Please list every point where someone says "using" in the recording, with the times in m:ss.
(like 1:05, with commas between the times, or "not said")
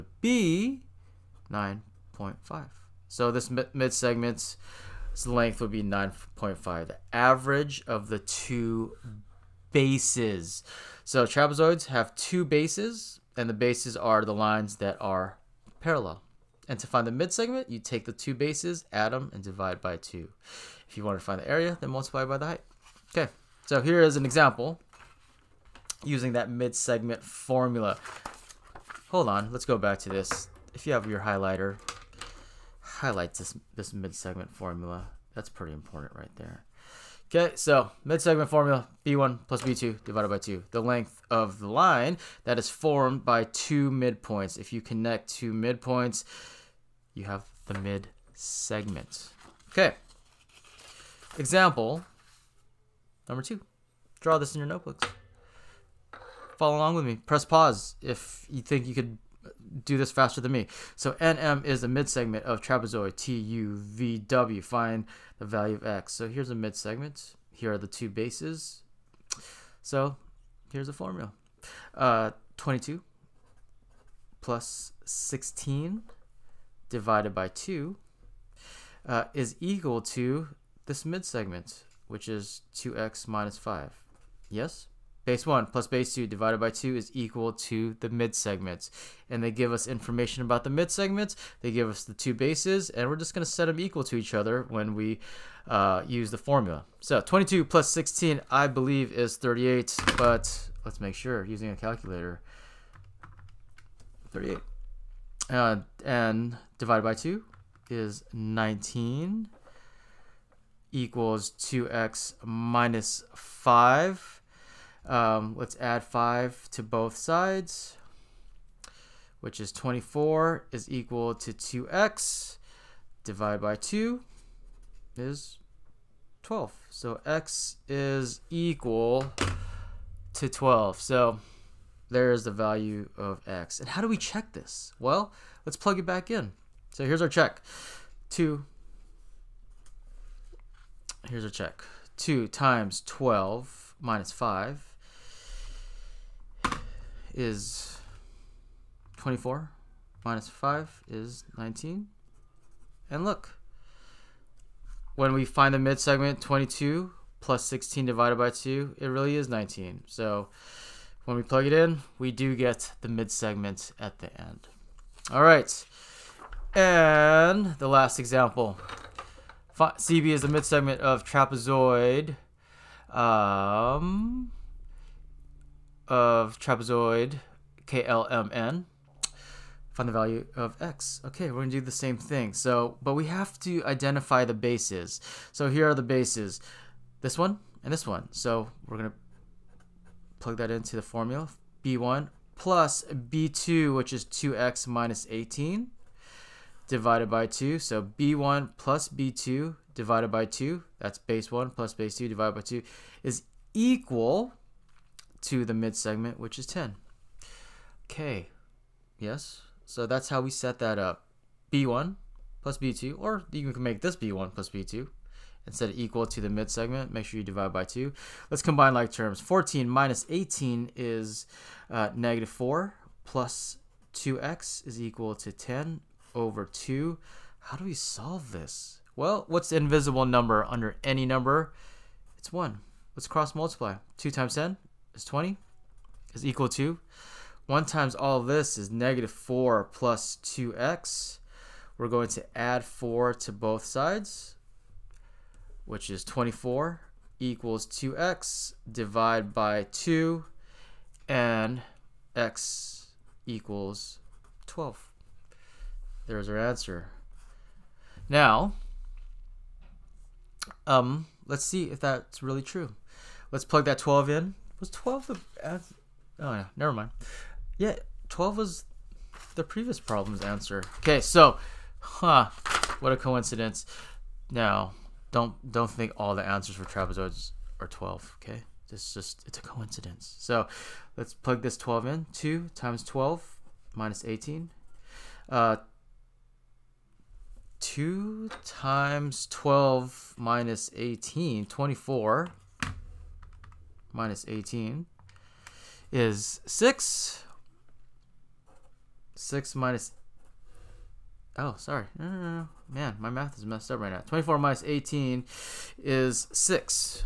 0:26, 1:41.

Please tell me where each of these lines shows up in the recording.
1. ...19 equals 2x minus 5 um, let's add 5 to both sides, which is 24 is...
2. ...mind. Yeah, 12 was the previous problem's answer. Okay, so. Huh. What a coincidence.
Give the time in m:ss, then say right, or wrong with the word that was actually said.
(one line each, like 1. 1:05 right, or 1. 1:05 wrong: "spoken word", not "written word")
1. 1:48 right
2. 4:26 right.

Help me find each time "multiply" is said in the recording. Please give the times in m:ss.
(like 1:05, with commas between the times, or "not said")
0:21, 3:53.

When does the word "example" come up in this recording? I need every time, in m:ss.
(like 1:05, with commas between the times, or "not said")
0:24, 0:51, 2:48.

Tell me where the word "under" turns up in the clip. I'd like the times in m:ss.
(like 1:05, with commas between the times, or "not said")
3:50.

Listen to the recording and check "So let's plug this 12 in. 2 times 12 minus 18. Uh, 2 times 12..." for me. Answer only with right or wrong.
right.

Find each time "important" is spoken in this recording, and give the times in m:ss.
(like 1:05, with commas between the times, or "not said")
0:35.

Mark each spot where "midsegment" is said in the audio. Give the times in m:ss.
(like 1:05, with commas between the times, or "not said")
0:17, 1:30.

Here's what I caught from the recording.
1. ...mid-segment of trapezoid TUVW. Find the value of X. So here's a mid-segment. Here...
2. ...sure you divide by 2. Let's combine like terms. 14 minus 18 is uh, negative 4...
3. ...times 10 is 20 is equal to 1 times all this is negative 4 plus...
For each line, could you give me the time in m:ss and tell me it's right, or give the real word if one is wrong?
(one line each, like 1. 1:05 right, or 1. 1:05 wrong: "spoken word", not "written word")
1. 1:01 right
2. 3:37 right
3. 3:54 right.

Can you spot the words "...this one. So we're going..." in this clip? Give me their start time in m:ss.
3:07.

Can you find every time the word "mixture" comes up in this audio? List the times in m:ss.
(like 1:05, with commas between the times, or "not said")
not said.